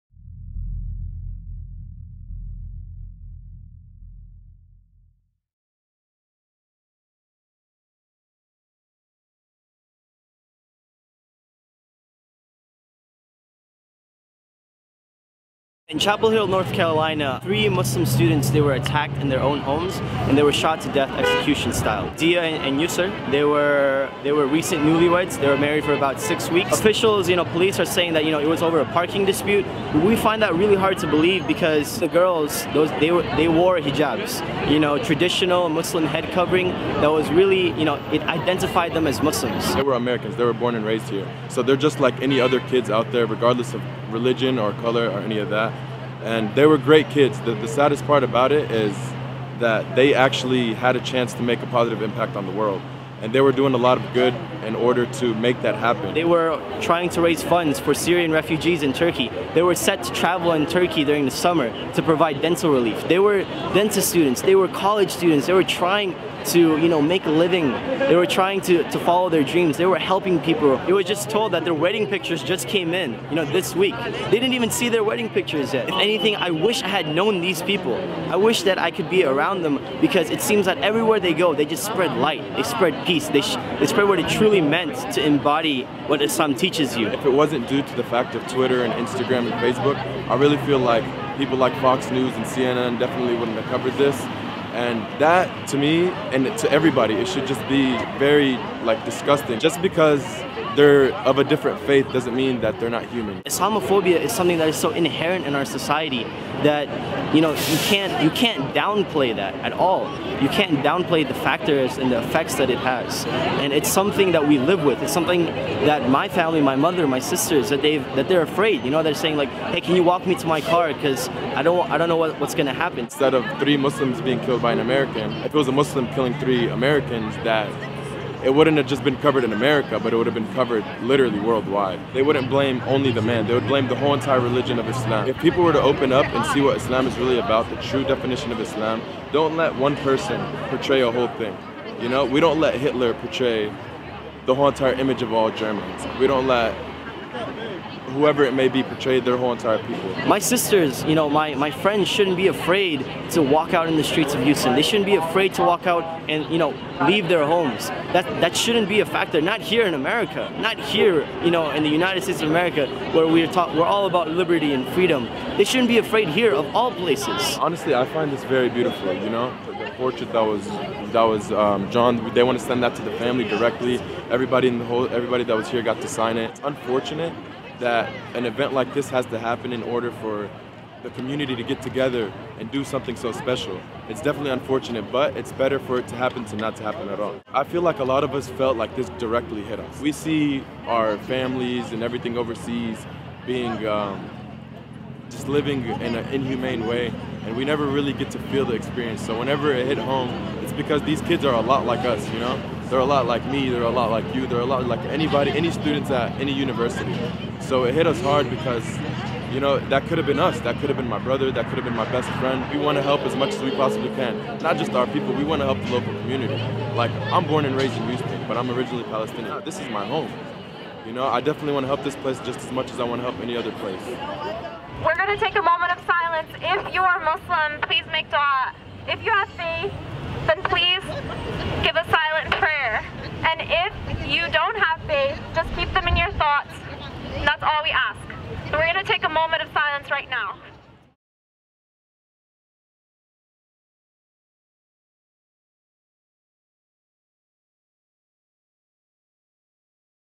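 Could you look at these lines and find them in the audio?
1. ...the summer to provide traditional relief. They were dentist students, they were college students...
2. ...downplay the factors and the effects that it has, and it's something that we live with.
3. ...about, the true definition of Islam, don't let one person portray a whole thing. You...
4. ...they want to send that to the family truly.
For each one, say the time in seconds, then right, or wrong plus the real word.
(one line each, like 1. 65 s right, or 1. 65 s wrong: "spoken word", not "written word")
1. 61 s wrong: "dental", not "traditional"
2. 110 s right
3. 137 s right
4. 172 s wrong: "directly", not "truly".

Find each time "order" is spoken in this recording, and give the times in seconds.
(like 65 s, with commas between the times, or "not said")
54 s, 179 s.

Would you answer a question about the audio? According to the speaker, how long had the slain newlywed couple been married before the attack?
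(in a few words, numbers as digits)
about 6 weeks.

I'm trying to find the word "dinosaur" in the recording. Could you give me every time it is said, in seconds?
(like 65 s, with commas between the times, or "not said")
not said.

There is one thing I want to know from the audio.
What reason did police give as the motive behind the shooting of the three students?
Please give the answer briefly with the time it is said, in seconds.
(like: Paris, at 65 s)
a parking dispute, at 28 s.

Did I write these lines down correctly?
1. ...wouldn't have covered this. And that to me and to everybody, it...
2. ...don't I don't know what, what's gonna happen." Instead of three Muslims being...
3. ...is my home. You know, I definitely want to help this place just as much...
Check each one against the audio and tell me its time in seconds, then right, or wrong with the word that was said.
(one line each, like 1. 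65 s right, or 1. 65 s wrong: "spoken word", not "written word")
1. 93 s right
2. 121 s right
3. 219 s right.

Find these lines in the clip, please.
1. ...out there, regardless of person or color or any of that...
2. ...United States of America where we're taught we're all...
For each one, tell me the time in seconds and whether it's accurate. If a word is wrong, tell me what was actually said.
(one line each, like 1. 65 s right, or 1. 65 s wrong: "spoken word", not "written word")
1. 42 s wrong: "religion", not "person"
2. 161 s right.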